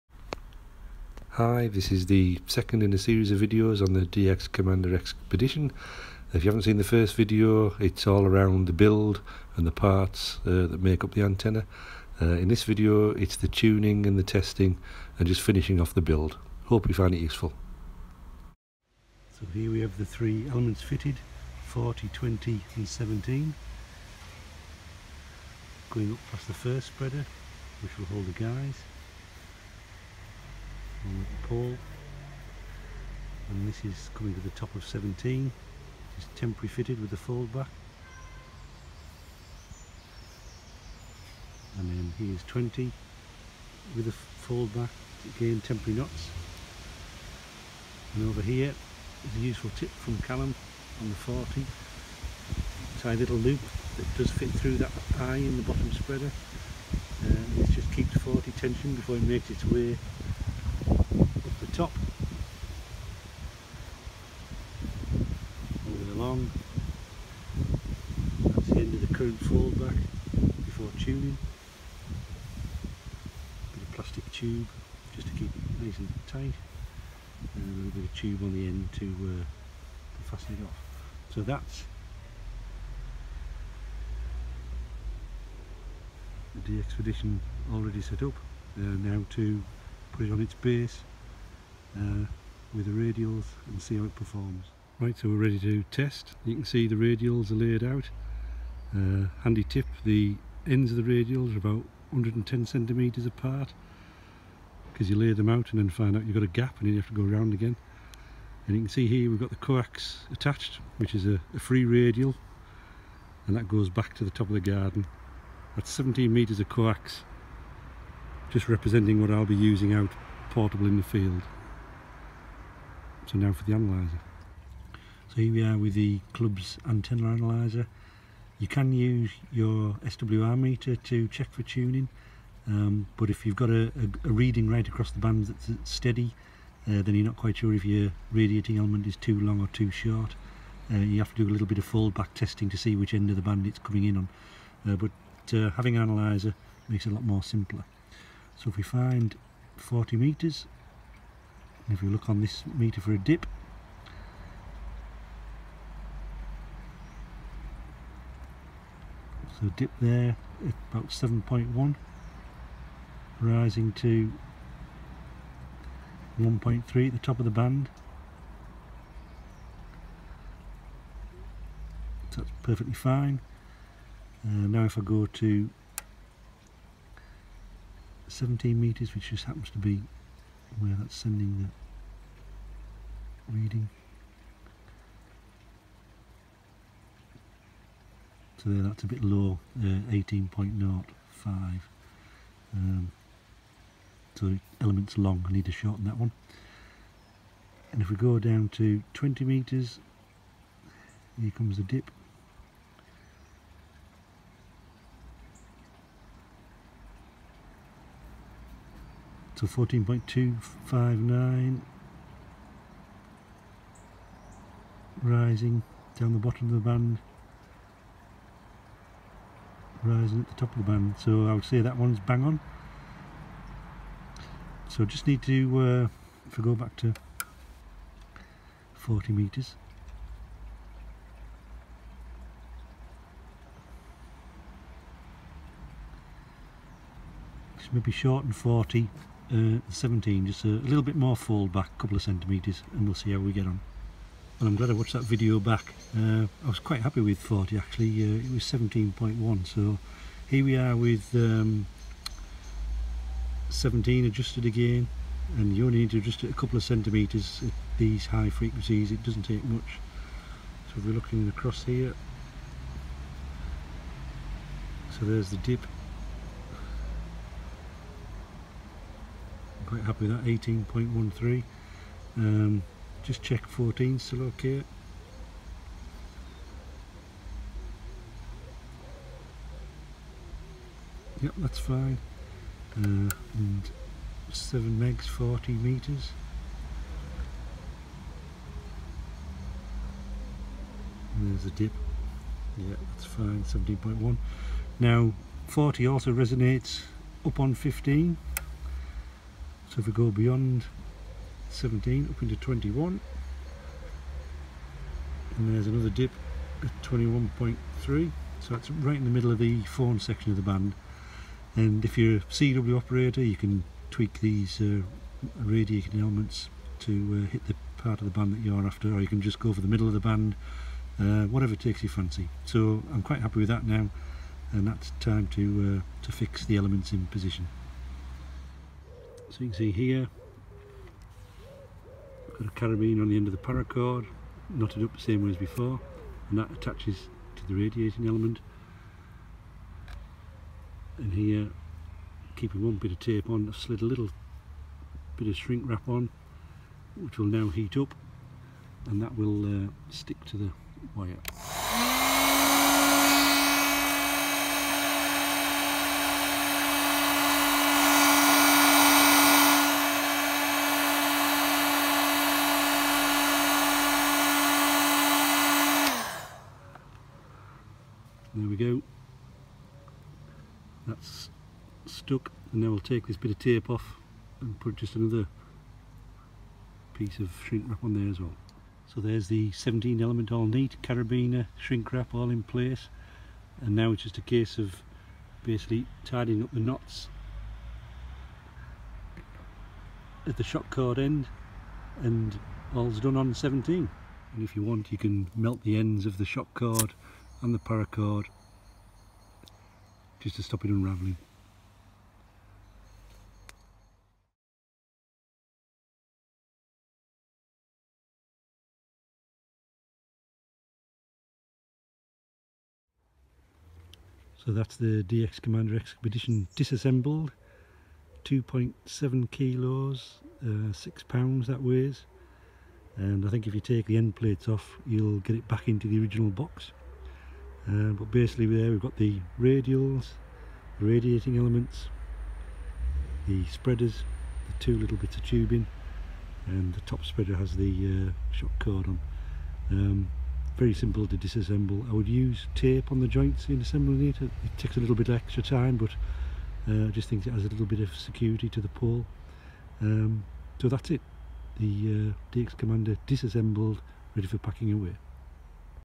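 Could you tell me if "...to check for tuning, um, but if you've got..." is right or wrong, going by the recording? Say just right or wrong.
right.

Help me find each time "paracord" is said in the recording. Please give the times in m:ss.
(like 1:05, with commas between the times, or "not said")
5:33, 6:37.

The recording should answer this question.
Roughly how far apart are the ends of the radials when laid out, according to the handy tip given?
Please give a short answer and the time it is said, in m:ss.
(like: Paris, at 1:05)
110 centimetres, at 1:42.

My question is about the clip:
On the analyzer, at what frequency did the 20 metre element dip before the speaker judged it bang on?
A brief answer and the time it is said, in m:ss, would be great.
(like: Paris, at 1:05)
14.259, at 3:29.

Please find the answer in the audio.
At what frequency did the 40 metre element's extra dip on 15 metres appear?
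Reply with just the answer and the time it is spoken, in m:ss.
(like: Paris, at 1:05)
21.3, at 5:07.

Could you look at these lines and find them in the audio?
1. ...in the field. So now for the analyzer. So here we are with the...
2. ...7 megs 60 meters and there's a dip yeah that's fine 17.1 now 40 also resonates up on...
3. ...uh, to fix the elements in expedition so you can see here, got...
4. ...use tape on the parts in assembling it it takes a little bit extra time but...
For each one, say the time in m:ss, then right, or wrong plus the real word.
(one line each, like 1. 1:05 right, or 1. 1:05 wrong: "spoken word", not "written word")
1. 2:00 right
2. 4:44 wrong: "40", not "60"
3. 5:26 wrong: "position", not "expedition"
4. 7:22 wrong: "joints", not "parts".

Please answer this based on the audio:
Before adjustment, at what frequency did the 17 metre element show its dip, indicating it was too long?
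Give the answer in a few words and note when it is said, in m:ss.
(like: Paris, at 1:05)
18.05, at 3:10.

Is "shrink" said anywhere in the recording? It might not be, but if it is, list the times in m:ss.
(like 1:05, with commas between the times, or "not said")
5:45, 6:17, 6:21.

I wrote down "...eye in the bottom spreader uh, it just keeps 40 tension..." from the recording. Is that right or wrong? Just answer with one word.
right.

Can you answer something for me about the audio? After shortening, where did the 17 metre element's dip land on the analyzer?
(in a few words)
18.13.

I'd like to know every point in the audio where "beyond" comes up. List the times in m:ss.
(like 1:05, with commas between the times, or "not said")
5:00.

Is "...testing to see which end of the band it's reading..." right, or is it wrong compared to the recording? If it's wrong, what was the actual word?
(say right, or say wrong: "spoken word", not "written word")
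wrong: "coming", not "reading".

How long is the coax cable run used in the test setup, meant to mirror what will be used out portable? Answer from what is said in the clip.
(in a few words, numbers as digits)
17 metres.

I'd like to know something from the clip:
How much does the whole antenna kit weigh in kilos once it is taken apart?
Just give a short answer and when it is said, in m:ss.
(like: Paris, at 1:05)
2.7 kilos, at 6:58.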